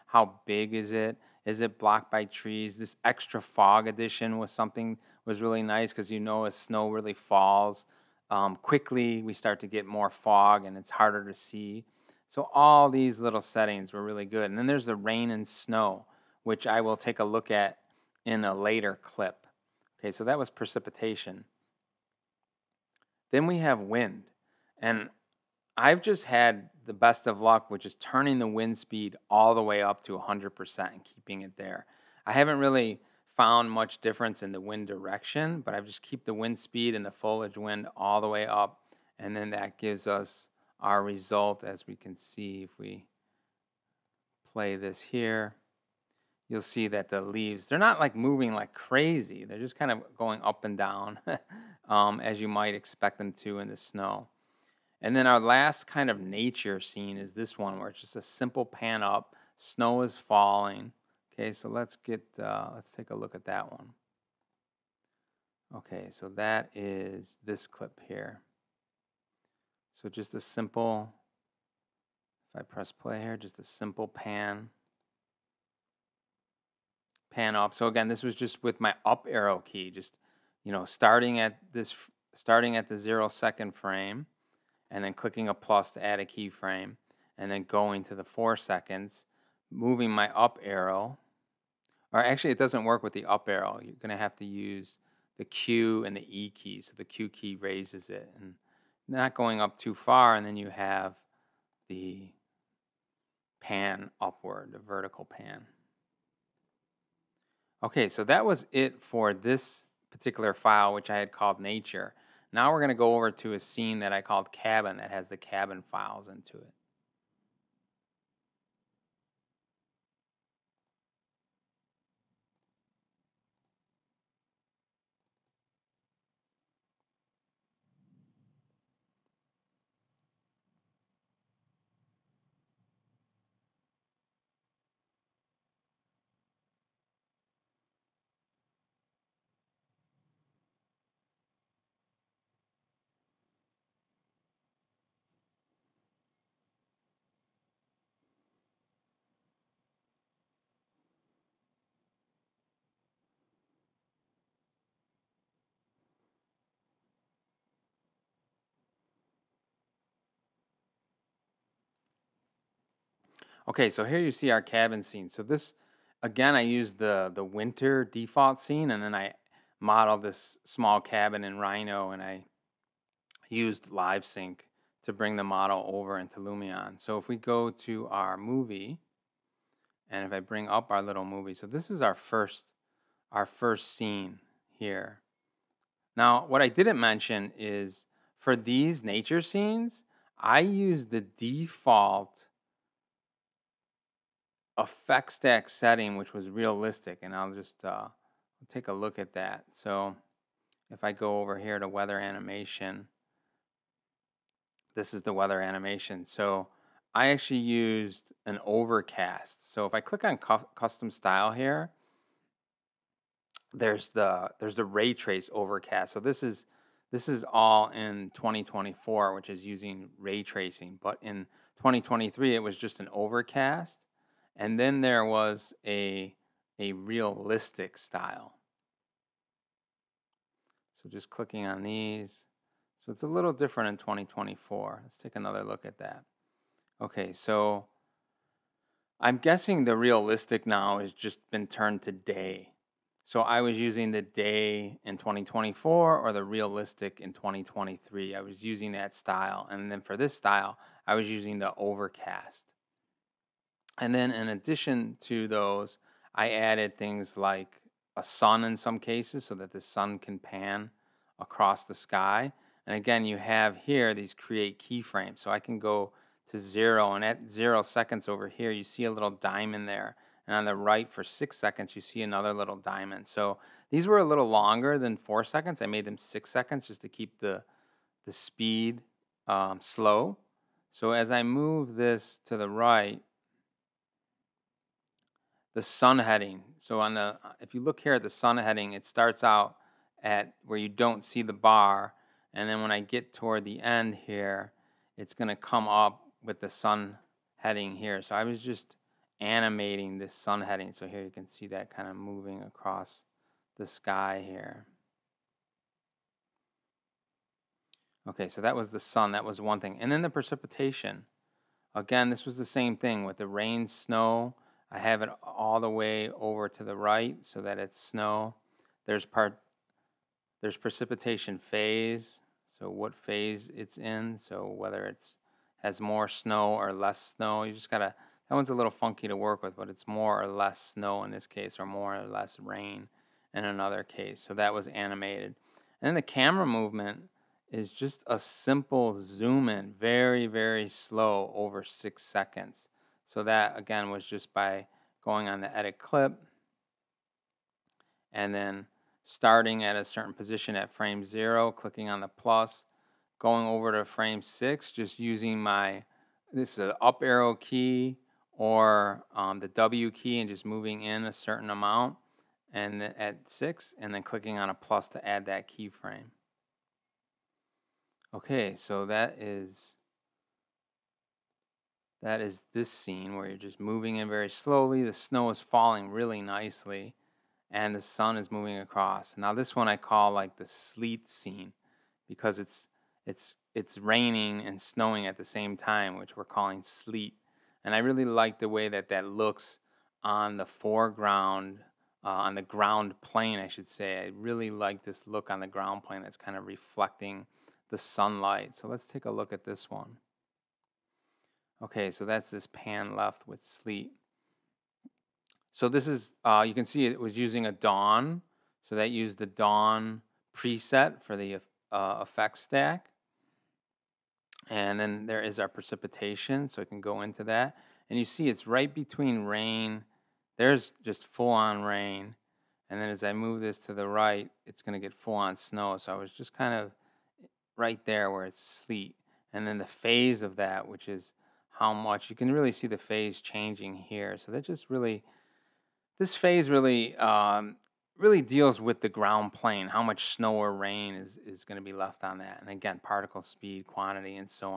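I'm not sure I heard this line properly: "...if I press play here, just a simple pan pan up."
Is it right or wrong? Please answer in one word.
right.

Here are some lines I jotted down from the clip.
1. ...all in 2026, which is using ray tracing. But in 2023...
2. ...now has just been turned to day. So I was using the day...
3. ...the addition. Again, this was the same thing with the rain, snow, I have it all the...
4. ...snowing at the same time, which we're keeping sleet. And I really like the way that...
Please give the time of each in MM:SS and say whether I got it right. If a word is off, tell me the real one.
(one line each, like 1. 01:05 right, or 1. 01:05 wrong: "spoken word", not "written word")
1. 03:37 wrong: "2024", not "2026"
2. 04:00 right
3. 05:10 wrong: "precipitation", not "addition"
4. 06:24 wrong: "calling", not "keeping".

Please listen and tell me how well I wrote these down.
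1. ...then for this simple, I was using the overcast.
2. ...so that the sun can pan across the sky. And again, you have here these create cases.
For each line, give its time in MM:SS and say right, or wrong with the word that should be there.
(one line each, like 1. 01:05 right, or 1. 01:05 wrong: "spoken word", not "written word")
1. 04:09 wrong: "style", not "simple"
2. 04:19 wrong: "keyframes", not "cases".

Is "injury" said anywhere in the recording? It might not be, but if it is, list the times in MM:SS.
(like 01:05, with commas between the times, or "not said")
not said.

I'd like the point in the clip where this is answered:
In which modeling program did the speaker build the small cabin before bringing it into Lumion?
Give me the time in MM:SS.
02:51.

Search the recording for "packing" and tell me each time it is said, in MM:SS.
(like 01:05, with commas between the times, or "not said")
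not said.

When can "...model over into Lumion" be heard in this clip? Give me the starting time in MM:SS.
02:55.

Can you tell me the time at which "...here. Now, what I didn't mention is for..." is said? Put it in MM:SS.
03:04.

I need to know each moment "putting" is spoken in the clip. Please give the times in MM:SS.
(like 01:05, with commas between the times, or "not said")
not said.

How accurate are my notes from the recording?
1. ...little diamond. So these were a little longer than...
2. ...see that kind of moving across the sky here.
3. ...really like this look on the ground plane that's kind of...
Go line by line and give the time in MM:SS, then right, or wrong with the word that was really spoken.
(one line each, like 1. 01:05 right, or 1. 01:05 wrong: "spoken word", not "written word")
1. 04:32 right
2. 05:01 right
3. 06:34 right.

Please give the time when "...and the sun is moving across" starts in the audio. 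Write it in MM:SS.
06:17.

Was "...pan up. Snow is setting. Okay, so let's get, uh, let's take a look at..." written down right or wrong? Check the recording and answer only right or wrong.
wrong.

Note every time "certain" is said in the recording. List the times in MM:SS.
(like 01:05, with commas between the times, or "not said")
05:50, 06:01.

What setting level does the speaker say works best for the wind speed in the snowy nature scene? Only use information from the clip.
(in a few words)
100%.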